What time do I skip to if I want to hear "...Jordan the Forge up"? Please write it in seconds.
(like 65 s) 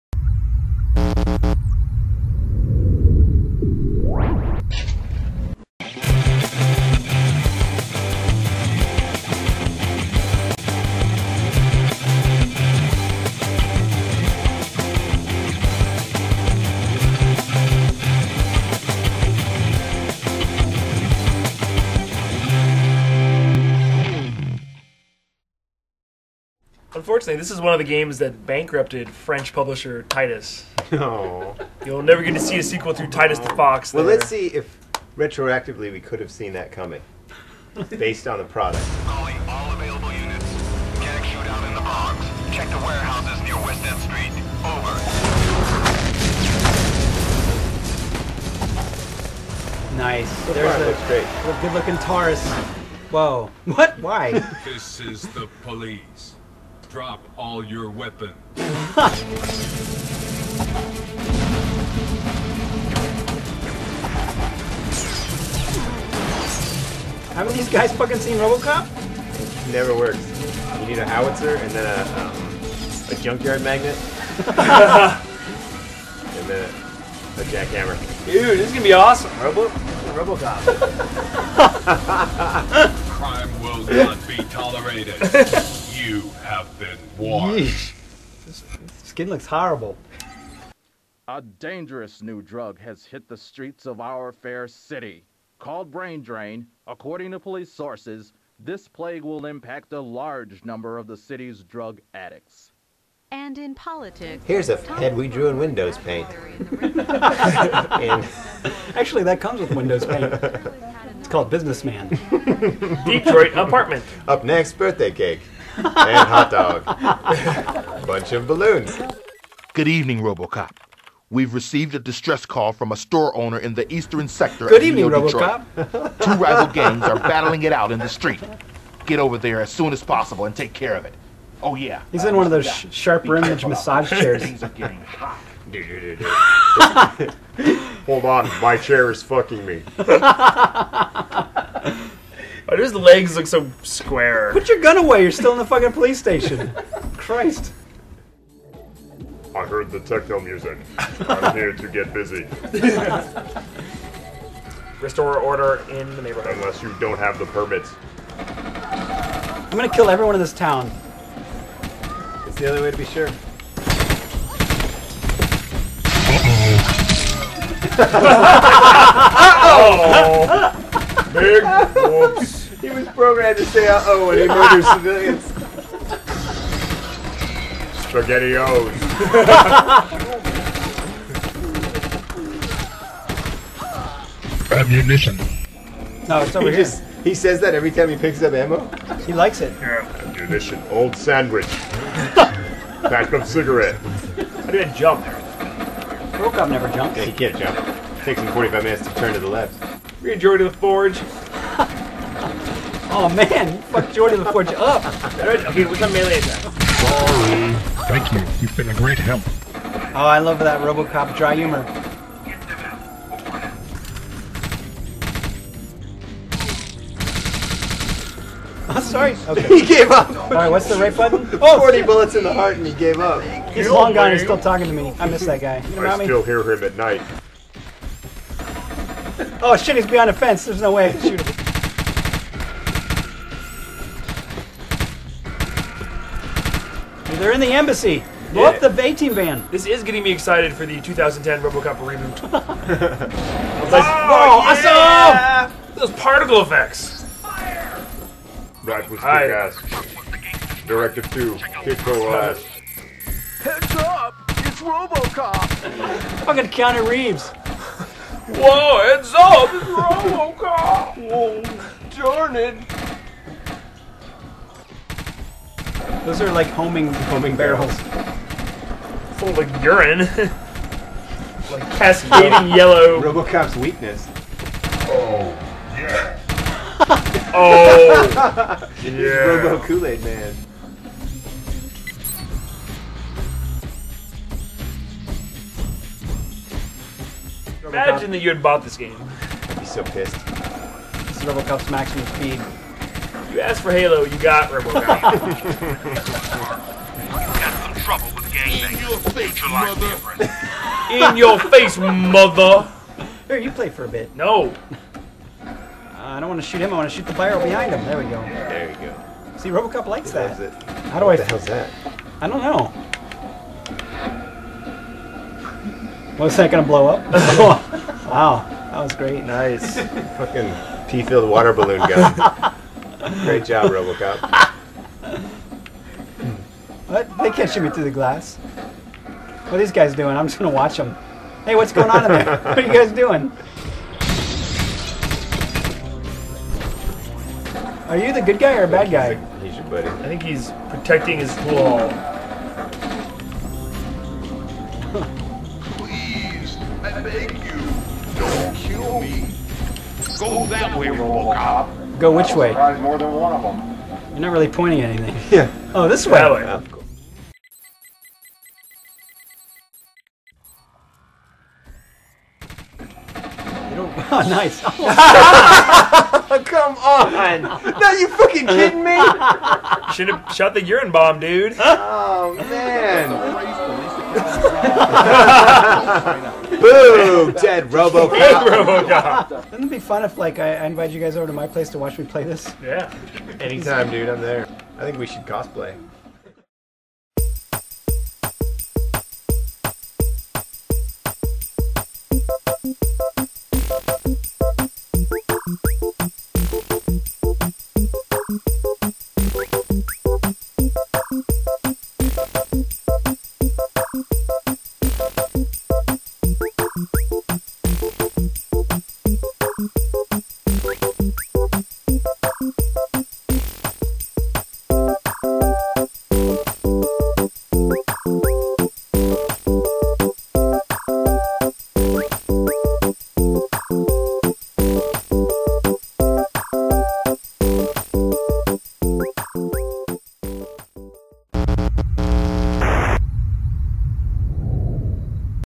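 204 s.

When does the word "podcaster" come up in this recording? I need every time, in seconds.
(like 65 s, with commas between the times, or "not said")
not said.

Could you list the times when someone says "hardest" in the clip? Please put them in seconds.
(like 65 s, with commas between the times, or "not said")
not said.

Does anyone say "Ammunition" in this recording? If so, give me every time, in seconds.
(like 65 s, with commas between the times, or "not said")
184 s, 189 s.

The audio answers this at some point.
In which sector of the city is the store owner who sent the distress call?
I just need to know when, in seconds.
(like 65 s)
123 s.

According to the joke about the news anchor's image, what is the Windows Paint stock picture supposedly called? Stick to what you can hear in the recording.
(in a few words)
Businessman.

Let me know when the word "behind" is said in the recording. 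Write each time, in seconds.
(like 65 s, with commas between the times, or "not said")
230 s, 307 s.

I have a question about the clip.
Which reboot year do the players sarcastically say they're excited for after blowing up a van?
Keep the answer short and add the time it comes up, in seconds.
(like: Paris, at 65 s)
2010, at 240 s.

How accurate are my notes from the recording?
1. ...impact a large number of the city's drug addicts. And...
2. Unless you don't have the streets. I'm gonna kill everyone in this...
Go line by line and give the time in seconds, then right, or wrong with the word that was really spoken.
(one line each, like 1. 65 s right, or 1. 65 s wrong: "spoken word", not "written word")
1. 99 s right
2. 156 s wrong: "permits", not "streets".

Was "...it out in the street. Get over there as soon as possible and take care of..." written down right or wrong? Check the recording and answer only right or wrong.
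right.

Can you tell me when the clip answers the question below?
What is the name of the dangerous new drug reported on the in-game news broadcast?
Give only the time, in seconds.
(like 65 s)
95 s.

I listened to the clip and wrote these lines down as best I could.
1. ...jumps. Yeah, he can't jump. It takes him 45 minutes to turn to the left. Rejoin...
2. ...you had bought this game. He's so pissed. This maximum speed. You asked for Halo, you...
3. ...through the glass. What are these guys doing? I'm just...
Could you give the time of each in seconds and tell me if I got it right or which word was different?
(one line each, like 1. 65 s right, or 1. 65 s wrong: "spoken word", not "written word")
1. 196 s right
2. 288 s right
3. 327 s right.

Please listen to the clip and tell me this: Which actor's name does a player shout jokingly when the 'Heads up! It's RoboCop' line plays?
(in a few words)
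Keanu Reeves.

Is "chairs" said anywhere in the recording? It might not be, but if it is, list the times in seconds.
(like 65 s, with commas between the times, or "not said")
134 s, 138 s.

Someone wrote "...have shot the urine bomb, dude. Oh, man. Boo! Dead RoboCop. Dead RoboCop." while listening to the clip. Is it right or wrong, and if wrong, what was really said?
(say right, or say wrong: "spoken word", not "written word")
right.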